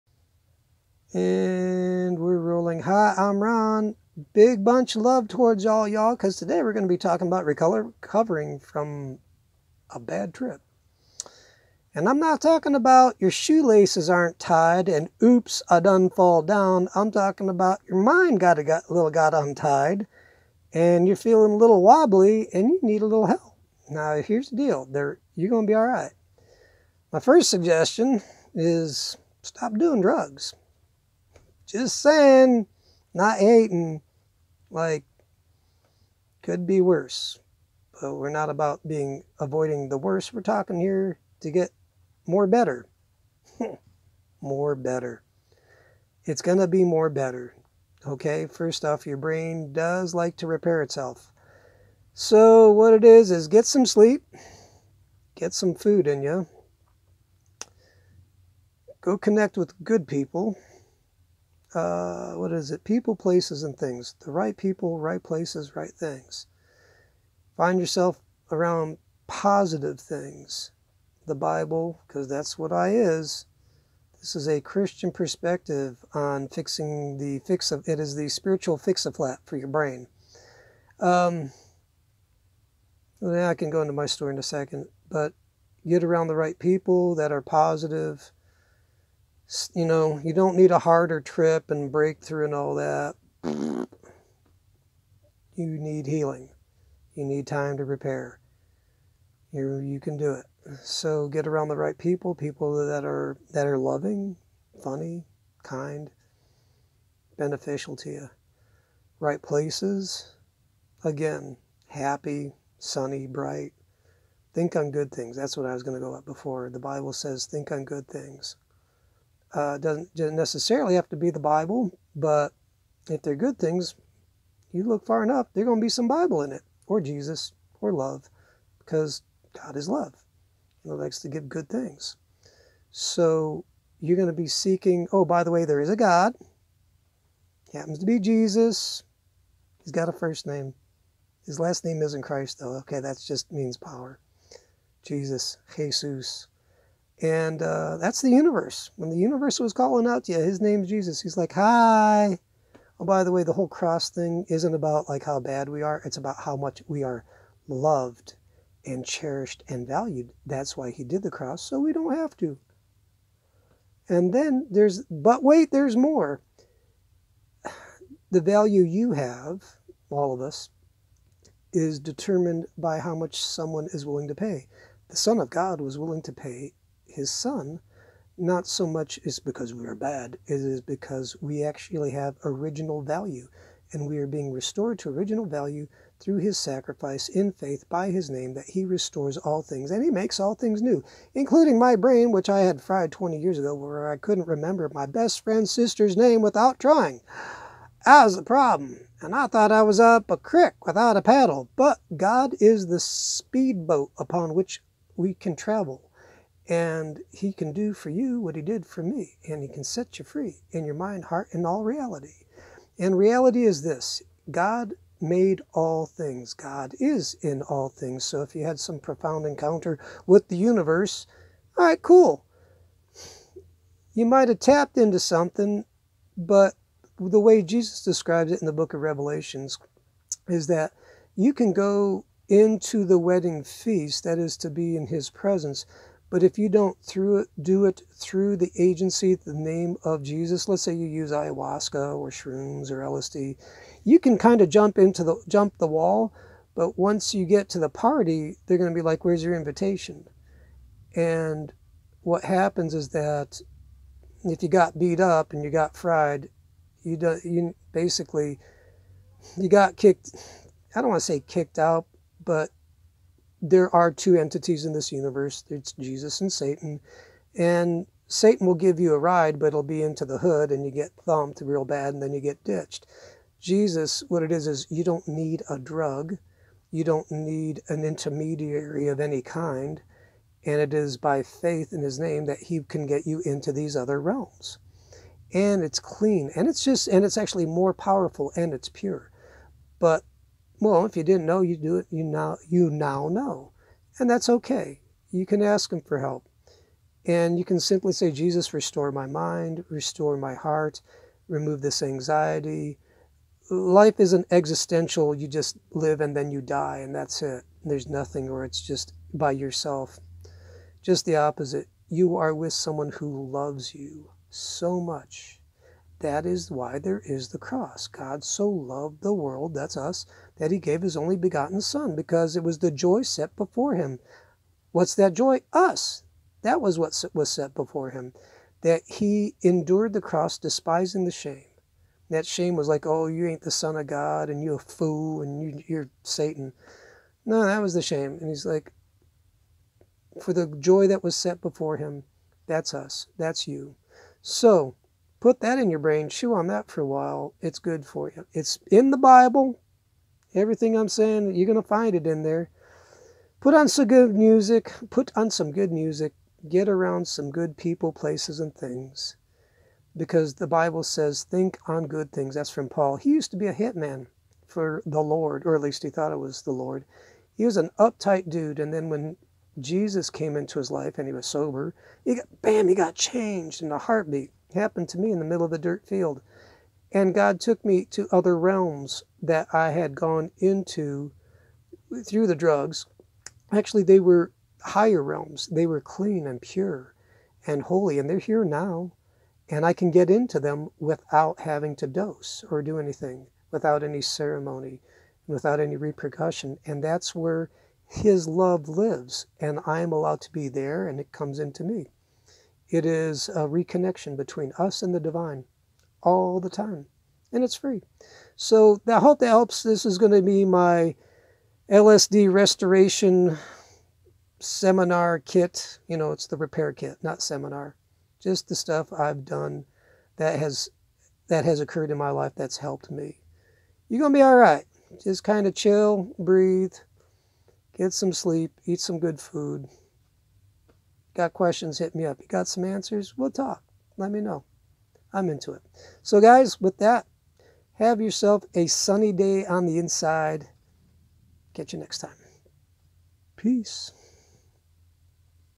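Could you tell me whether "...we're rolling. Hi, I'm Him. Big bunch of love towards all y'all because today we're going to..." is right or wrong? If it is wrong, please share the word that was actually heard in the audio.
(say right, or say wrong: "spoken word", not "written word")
wrong: "Ron", not "Him".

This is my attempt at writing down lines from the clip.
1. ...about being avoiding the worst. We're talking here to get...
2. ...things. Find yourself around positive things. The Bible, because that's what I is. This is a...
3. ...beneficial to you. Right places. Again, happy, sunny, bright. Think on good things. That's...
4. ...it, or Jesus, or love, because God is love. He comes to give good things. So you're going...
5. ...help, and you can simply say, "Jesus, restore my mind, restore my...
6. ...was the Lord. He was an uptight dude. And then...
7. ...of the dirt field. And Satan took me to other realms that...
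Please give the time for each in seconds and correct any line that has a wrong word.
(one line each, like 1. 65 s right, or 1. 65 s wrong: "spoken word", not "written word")
1. 38 s right
2. 65 s right
3. 107 s right
4. 126 s wrong: "likes", not "comes"
5. 296 s right
6. 366 s right
7. 375 s wrong: "God", not "Satan".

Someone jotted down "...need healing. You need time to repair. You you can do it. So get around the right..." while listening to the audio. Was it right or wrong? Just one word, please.
right.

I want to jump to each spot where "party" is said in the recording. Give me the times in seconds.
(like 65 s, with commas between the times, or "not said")
247 s.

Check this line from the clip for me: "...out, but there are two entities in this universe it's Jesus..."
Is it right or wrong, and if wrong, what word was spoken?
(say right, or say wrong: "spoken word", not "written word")
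right.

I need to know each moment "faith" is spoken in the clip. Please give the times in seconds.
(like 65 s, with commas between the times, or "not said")
187 s, 281 s.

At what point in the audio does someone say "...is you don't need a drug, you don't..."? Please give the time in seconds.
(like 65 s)
274 s.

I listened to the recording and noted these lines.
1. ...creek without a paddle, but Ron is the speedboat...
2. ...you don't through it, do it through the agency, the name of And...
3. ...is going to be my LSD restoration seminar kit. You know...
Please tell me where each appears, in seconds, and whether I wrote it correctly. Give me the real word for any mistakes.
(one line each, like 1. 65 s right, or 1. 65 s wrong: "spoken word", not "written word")
1. 200 s wrong: "God", not "Ron"
2. 236 s wrong: "Jesus", not "And"
3. 410 s right.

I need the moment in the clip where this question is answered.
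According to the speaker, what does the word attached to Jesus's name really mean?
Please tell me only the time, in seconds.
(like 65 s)
143 s.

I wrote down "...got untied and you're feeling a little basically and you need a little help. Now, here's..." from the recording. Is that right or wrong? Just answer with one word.
wrong.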